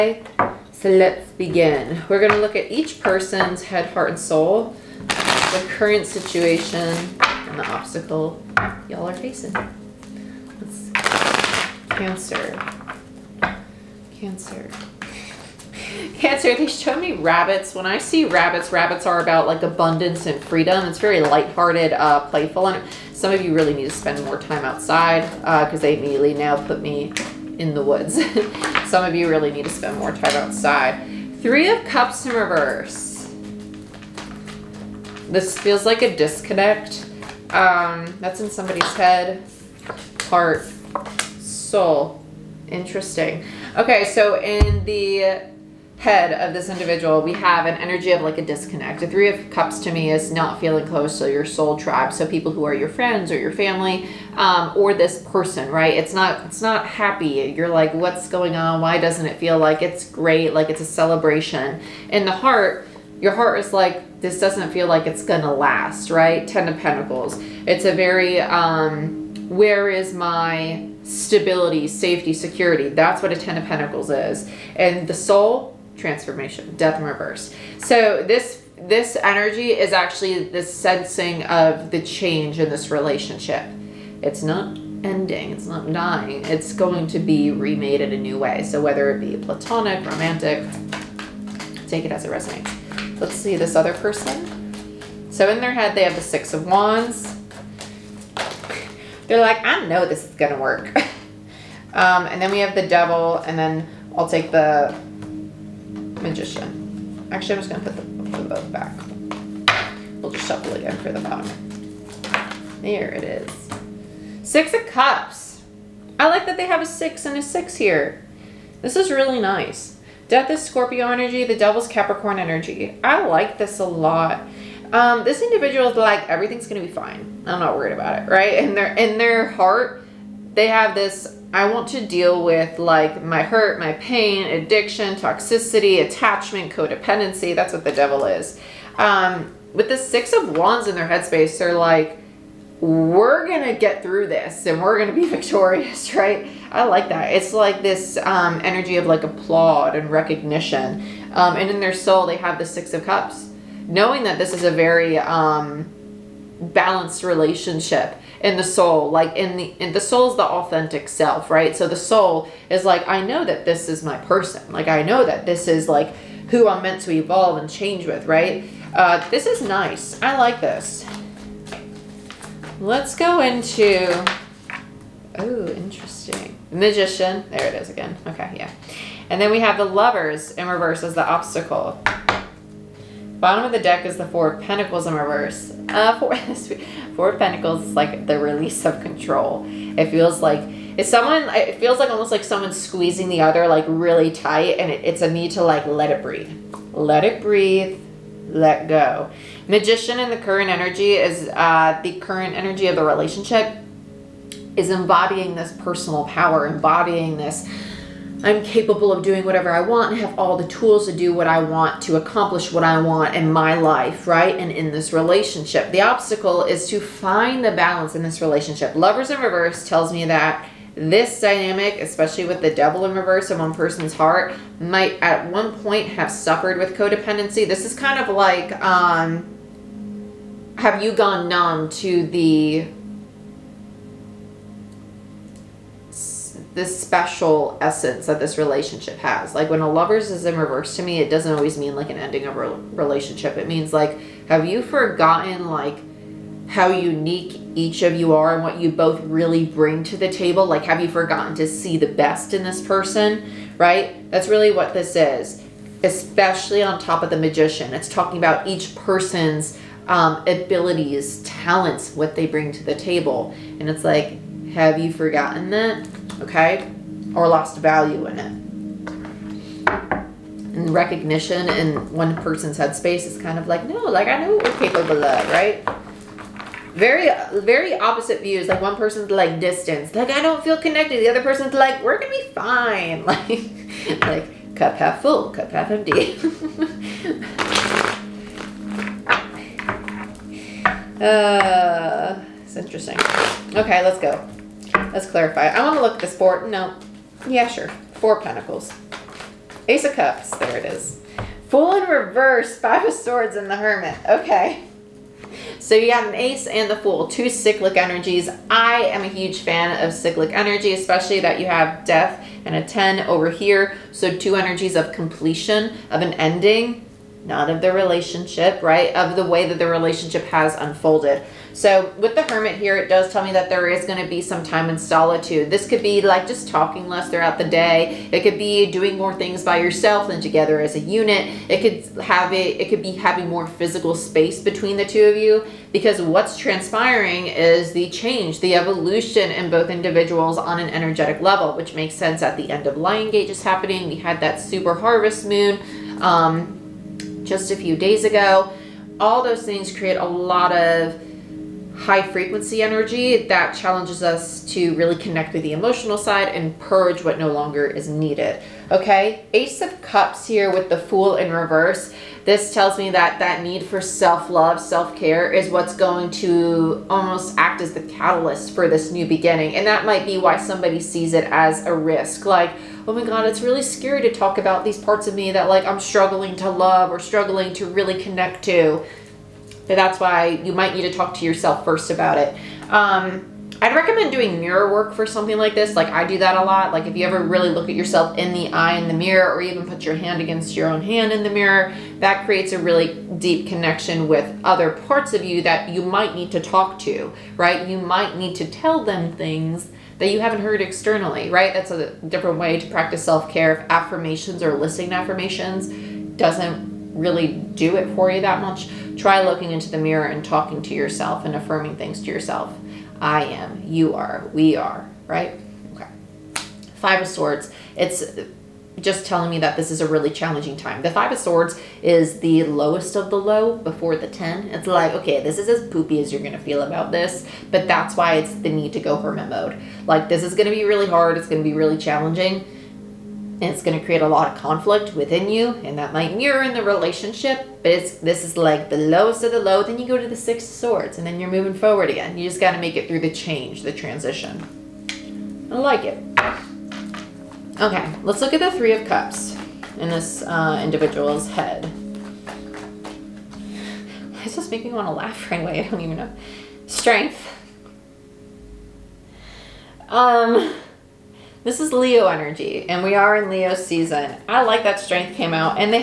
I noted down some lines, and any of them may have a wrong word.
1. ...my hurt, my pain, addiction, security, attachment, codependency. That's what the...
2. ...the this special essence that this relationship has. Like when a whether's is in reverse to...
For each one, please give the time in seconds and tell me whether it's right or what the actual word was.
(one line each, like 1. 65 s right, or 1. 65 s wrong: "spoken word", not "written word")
1. 133 s wrong: "toxicity", not "security"
2. 232 s wrong: "lover", not "whether".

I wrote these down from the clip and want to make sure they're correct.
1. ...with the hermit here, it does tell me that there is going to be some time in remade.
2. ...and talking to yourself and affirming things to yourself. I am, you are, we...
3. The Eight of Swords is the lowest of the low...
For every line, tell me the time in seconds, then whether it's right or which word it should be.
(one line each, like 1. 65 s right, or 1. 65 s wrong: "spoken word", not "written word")
1. 322 s wrong: "solitude", not "remade"
2. 410 s right
3. 421 s wrong: "Five", not "Eight".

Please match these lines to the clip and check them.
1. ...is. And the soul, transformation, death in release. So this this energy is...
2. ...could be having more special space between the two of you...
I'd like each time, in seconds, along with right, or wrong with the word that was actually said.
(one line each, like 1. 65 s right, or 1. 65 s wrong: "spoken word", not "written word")
1. 74 s wrong: "reverse", not "release"
2. 332 s wrong: "physical", not "special".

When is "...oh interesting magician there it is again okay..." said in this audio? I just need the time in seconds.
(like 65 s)
175 s.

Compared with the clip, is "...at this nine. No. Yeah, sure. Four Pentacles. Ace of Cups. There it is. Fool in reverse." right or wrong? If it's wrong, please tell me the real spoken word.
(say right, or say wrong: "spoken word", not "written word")
wrong: "four", not "nine".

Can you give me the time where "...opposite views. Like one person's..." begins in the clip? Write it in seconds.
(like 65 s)
277 s.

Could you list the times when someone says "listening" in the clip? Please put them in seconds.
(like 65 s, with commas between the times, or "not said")
404 s.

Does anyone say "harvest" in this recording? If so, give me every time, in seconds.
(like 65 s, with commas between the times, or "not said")
344 s.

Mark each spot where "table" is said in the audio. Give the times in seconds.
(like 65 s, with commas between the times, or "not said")
250 s, 262 s.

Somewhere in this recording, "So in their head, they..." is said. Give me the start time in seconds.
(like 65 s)
95 s.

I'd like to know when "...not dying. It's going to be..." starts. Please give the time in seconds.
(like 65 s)
85 s.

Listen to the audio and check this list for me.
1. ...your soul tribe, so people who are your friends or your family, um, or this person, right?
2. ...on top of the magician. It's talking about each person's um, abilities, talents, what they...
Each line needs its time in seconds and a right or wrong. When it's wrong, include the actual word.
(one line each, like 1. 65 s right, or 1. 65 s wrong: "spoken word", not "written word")
1. 51 s right
2. 256 s right.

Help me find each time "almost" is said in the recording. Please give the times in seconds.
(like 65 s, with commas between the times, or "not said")
192 s, 367 s.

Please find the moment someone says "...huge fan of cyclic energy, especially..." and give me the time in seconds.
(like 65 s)
309 s.